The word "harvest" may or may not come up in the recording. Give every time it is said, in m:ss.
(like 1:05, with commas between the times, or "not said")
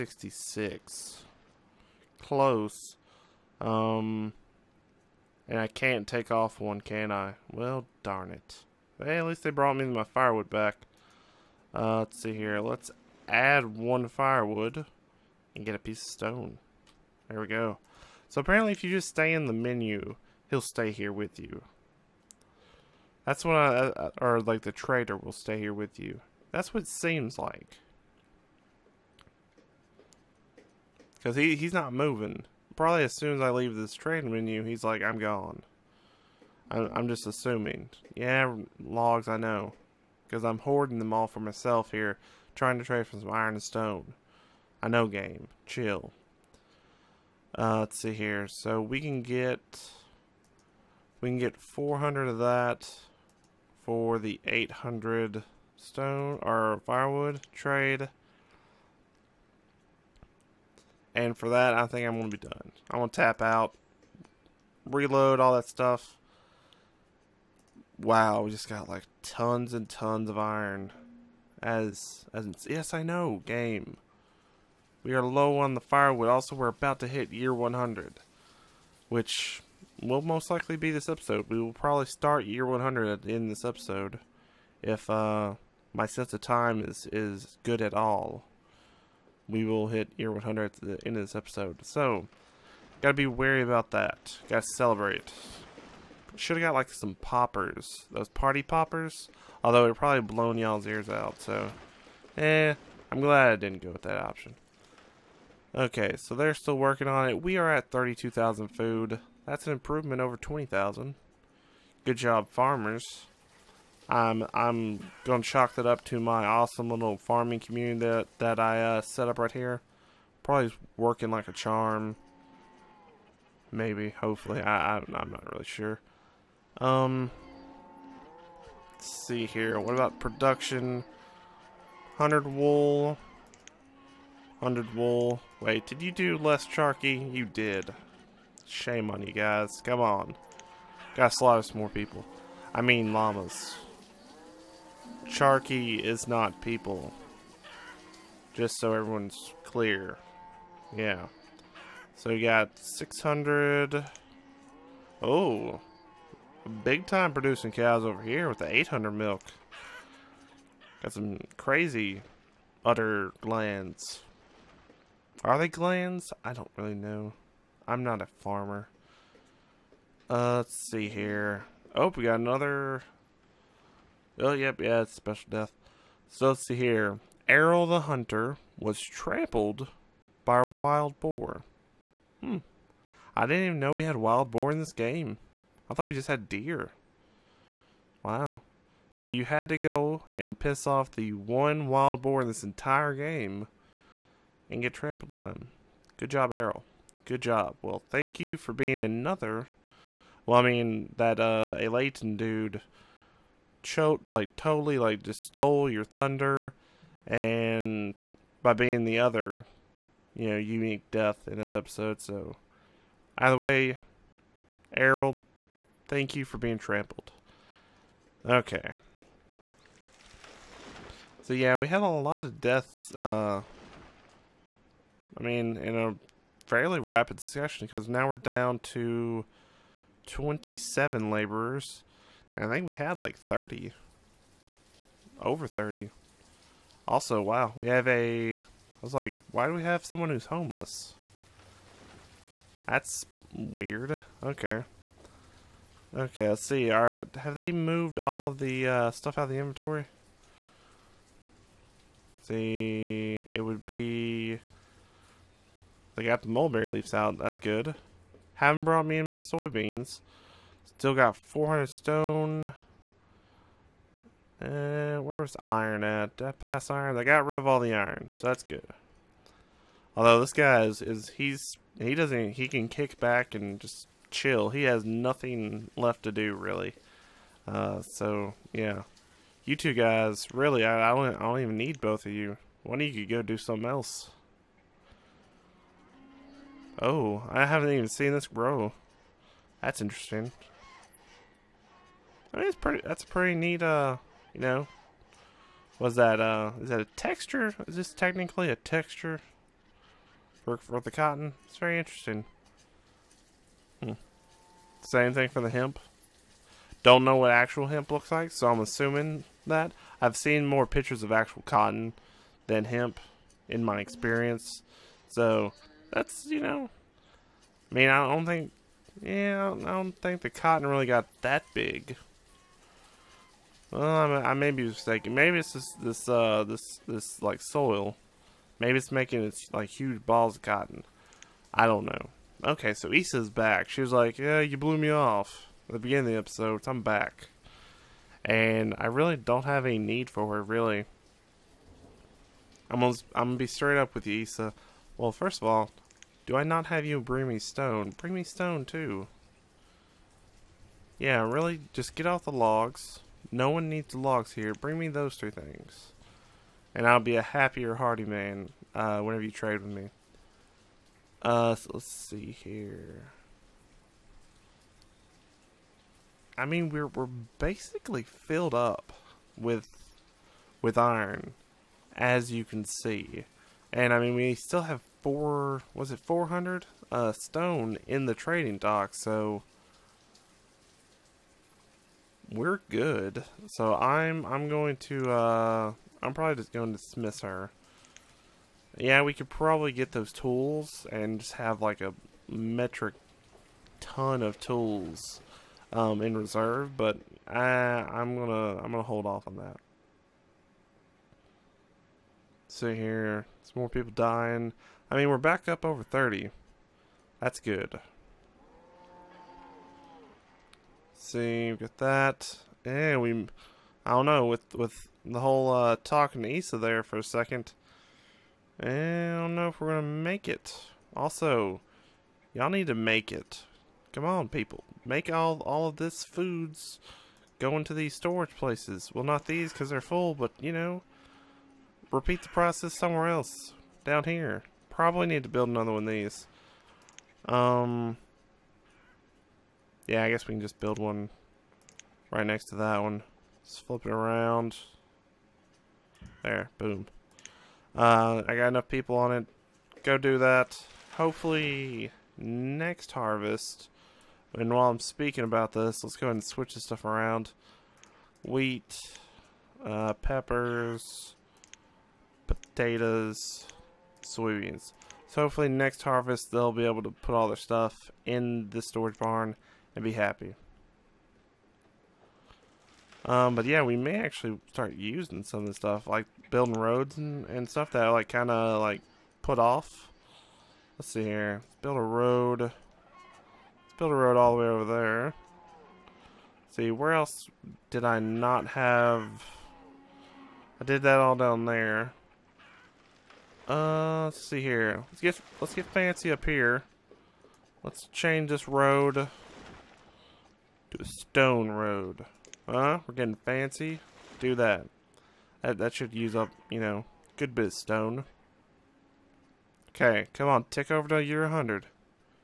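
7:33, 7:46.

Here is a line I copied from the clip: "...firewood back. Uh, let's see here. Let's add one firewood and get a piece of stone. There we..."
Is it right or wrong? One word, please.
right.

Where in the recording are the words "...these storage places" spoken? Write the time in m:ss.
7:07.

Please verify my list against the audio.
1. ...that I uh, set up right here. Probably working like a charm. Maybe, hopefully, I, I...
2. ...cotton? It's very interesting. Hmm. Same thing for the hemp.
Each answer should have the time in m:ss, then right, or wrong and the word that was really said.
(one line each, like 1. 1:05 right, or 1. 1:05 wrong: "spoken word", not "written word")
1. 1:58 right
2. 5:01 right.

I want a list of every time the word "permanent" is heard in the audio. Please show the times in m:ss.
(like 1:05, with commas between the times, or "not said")
not said.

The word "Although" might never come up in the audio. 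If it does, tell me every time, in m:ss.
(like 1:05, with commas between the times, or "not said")
1:39, 4:30.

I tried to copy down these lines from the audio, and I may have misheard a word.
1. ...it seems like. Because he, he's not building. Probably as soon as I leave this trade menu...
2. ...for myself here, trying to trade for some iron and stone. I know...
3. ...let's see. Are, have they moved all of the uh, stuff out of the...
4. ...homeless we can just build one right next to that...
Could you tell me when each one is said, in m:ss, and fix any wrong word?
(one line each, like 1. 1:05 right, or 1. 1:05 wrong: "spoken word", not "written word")
1. 0:26 wrong: "moving", not "building"
2. 0:41 right
3. 4:06 right
4. 7:20 wrong: "guess", not "homeless".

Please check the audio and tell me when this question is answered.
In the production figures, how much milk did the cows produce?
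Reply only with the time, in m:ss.
2:38.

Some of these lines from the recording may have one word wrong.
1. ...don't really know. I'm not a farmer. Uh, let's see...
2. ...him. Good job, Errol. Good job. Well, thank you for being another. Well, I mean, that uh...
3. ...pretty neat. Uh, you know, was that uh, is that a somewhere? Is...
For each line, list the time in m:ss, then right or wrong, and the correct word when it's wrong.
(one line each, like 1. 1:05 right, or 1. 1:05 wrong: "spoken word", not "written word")
1. 2:46 right
2. 3:15 right
3. 4:53 wrong: "texture", not "somewhere".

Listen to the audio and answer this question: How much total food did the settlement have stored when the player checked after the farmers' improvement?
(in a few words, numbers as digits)
32,000.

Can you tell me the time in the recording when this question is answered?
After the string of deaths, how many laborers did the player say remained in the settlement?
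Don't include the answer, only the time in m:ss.
3:50.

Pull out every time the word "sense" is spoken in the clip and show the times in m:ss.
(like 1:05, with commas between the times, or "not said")
1:26.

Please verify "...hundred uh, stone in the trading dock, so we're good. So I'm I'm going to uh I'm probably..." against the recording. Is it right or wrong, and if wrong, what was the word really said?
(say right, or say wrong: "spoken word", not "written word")
right.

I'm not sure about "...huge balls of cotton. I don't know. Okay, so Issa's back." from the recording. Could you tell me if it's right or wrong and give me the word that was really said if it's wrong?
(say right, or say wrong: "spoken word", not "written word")
right.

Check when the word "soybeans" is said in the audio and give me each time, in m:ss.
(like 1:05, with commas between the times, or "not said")
4:19, 7:44.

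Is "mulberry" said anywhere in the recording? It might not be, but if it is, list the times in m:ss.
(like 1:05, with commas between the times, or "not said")
4:16.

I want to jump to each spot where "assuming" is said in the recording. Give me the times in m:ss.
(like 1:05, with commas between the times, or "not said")
0:37, 5:08.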